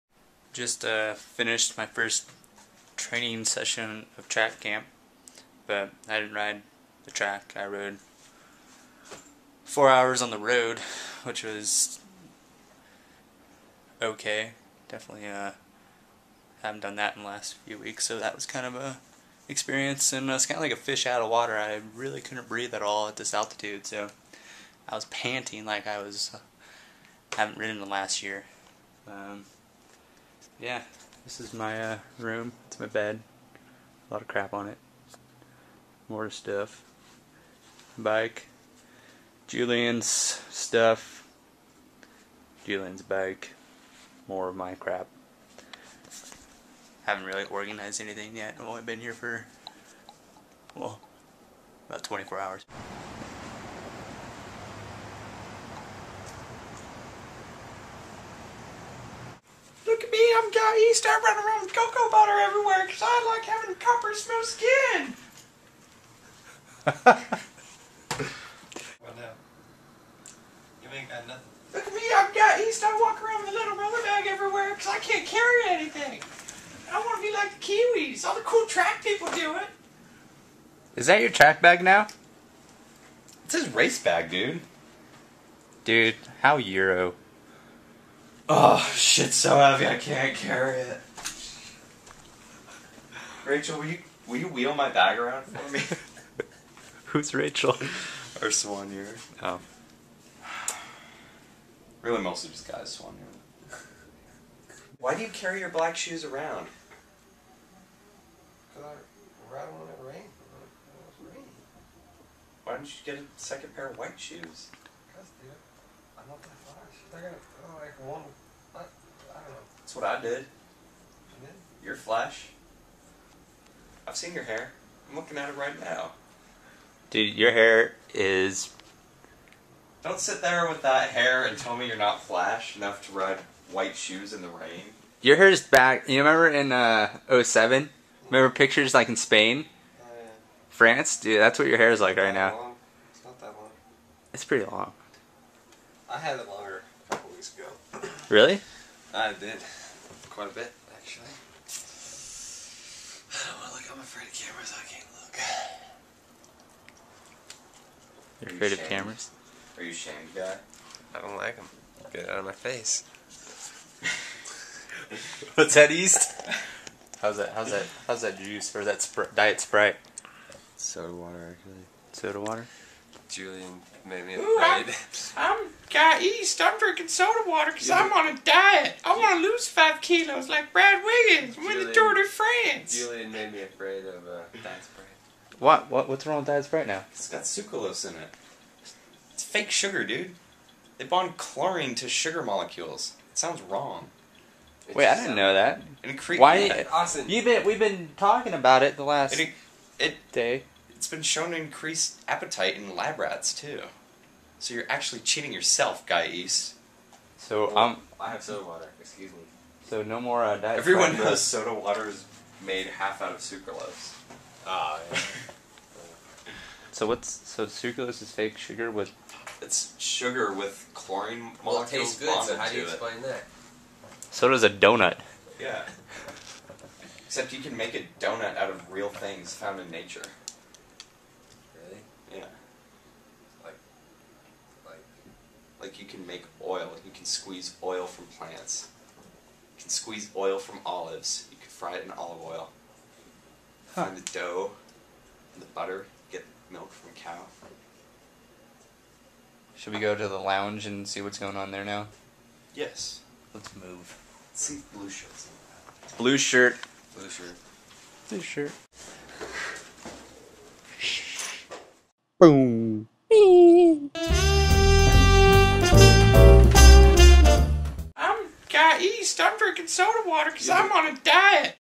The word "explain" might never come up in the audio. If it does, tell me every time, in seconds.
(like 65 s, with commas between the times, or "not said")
222 s.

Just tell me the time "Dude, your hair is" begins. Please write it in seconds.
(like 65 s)
127 s.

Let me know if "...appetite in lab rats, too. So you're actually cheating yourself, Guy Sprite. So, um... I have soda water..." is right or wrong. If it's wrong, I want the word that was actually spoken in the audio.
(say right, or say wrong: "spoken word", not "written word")
wrong: "East", not "Sprite".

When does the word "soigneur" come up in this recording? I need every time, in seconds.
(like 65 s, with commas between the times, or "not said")
98 s, 103 s.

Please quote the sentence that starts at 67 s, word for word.
What now, you ain't got nothing.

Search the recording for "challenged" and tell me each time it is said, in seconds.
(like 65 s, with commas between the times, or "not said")
not said.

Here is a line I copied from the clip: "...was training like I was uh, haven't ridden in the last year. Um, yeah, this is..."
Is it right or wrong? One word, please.
wrong.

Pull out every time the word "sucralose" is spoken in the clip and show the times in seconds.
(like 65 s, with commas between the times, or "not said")
187 s, 213 s, 217 s.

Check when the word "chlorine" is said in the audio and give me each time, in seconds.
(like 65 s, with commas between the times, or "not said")
191 s, 220 s.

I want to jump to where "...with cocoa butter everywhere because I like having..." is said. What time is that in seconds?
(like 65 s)
61 s.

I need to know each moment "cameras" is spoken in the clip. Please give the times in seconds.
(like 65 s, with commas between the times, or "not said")
154 s, 158 s.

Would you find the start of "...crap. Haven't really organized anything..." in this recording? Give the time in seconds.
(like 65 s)
44 s.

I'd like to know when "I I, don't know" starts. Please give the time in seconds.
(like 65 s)
117 s.